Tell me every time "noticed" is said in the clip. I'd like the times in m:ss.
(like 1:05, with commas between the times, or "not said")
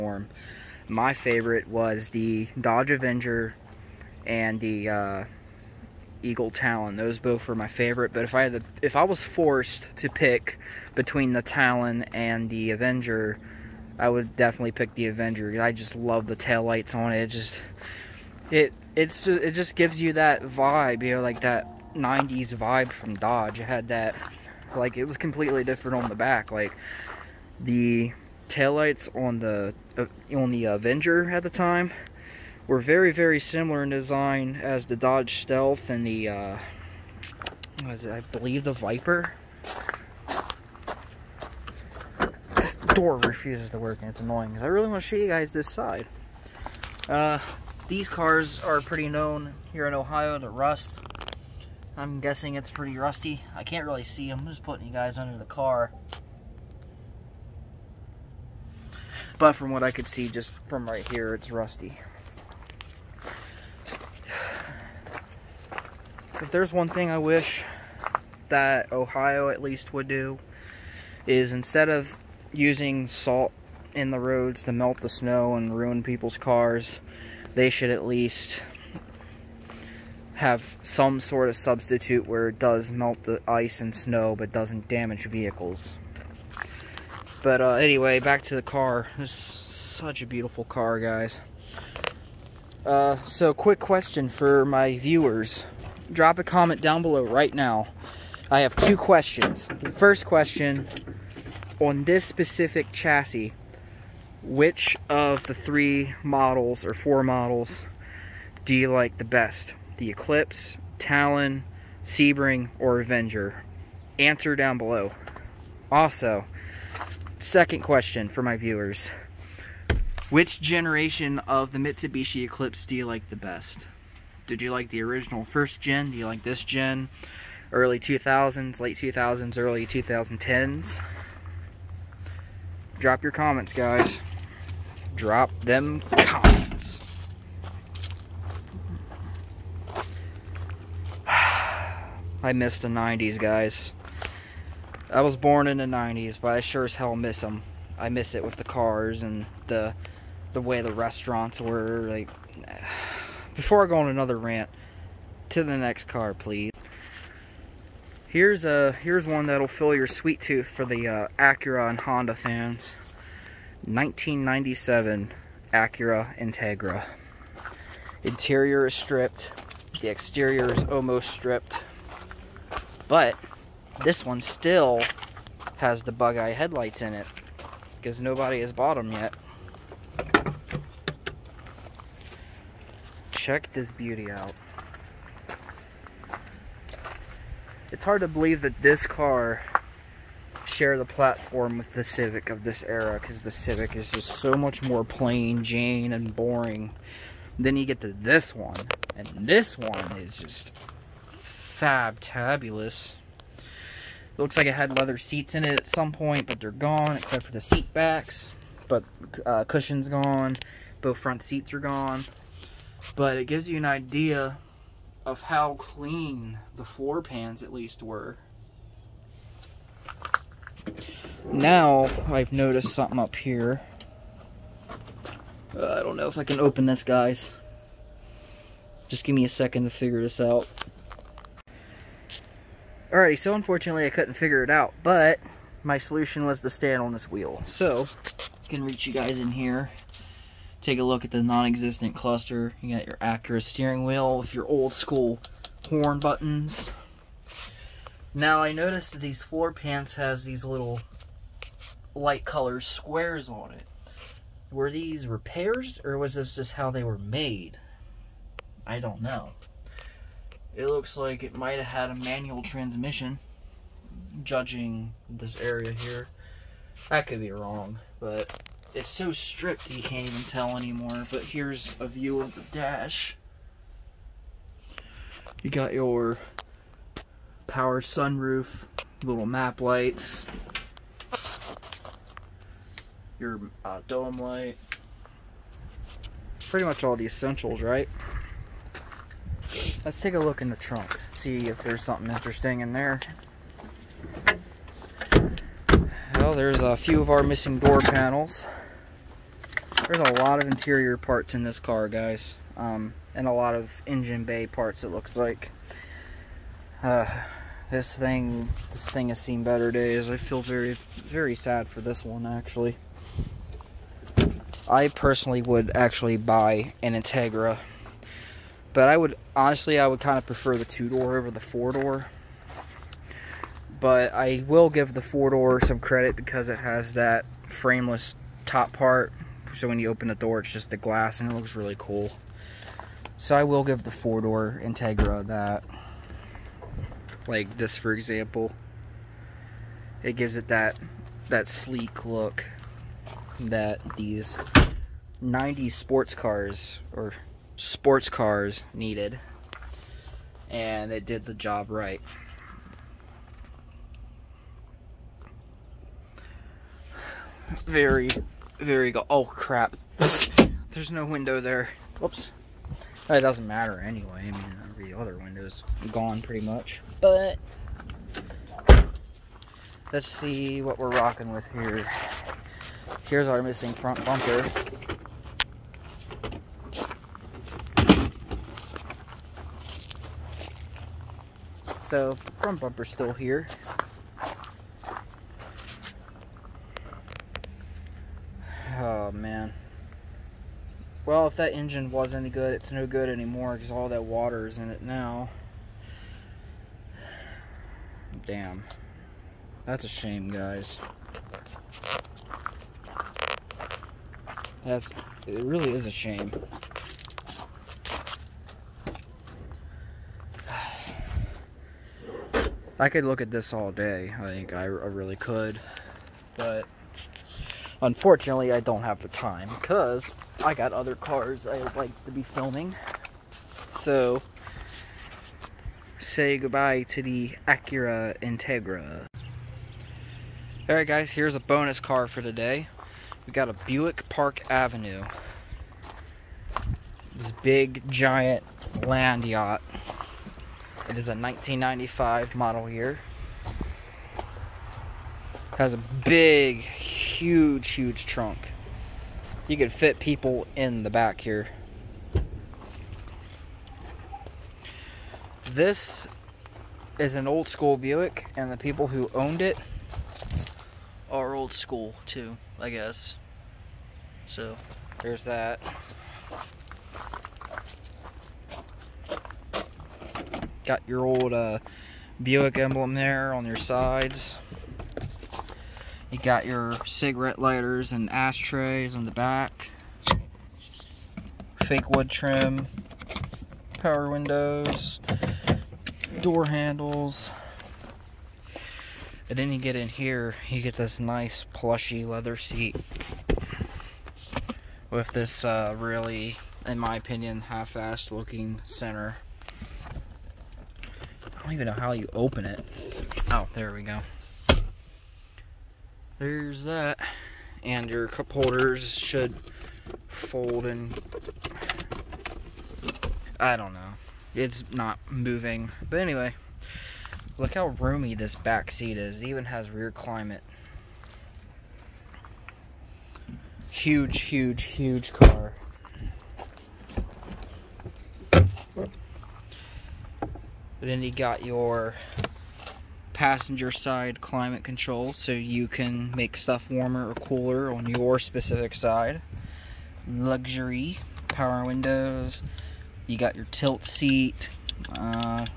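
3:42, 4:08.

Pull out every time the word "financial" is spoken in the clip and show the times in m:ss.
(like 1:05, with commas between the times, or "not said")
not said.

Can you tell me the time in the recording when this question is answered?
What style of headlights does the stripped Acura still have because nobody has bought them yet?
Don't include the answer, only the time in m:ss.
2:56.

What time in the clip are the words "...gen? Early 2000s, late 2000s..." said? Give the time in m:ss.
2:06.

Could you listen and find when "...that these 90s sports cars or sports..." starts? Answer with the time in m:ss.
5:43.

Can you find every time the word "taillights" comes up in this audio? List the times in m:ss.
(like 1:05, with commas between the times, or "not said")
0:16, 0:28.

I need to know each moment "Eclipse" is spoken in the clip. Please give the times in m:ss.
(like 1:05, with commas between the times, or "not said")
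1:50, 2:02.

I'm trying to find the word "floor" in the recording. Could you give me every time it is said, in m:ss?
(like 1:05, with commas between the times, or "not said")
3:36, 4:09.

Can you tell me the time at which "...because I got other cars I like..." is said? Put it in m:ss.
6:59.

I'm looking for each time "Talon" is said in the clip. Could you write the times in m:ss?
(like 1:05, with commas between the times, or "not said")
0:06, 0:11, 1:50.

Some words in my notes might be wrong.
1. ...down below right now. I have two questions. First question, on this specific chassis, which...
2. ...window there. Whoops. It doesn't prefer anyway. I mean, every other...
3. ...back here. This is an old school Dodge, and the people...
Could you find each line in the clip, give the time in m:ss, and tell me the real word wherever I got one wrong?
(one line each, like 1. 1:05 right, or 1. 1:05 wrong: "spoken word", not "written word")
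1. 1:36 right
2. 6:01 wrong: "matter", not "prefer"
3. 7:31 wrong: "Buick", not "Dodge".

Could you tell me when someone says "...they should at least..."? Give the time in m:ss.
1:17.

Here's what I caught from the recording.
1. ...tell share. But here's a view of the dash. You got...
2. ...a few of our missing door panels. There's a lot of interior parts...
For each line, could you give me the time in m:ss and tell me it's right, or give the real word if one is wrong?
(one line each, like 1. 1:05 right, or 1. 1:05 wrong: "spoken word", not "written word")
1. 4:30 wrong: "anymore", not "share"
2. 4:56 right.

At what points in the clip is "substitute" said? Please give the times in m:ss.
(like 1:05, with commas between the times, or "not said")
1:21.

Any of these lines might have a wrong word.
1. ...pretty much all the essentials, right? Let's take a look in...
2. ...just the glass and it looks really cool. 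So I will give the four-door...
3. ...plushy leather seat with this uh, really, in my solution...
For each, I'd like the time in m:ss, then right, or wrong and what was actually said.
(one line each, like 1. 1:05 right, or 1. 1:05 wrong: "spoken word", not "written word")
1. 4:46 right
2. 5:30 right
3. 8:11 wrong: "opinion", not "solution".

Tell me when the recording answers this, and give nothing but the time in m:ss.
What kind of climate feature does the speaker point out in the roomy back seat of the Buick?
8:39.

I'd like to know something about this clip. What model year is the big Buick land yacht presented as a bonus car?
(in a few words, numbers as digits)
1995.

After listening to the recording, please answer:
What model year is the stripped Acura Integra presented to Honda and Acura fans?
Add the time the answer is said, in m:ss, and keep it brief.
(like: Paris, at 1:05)
1997, at 2:43.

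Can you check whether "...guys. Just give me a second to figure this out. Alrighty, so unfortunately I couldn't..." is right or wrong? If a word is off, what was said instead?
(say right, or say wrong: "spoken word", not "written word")
right.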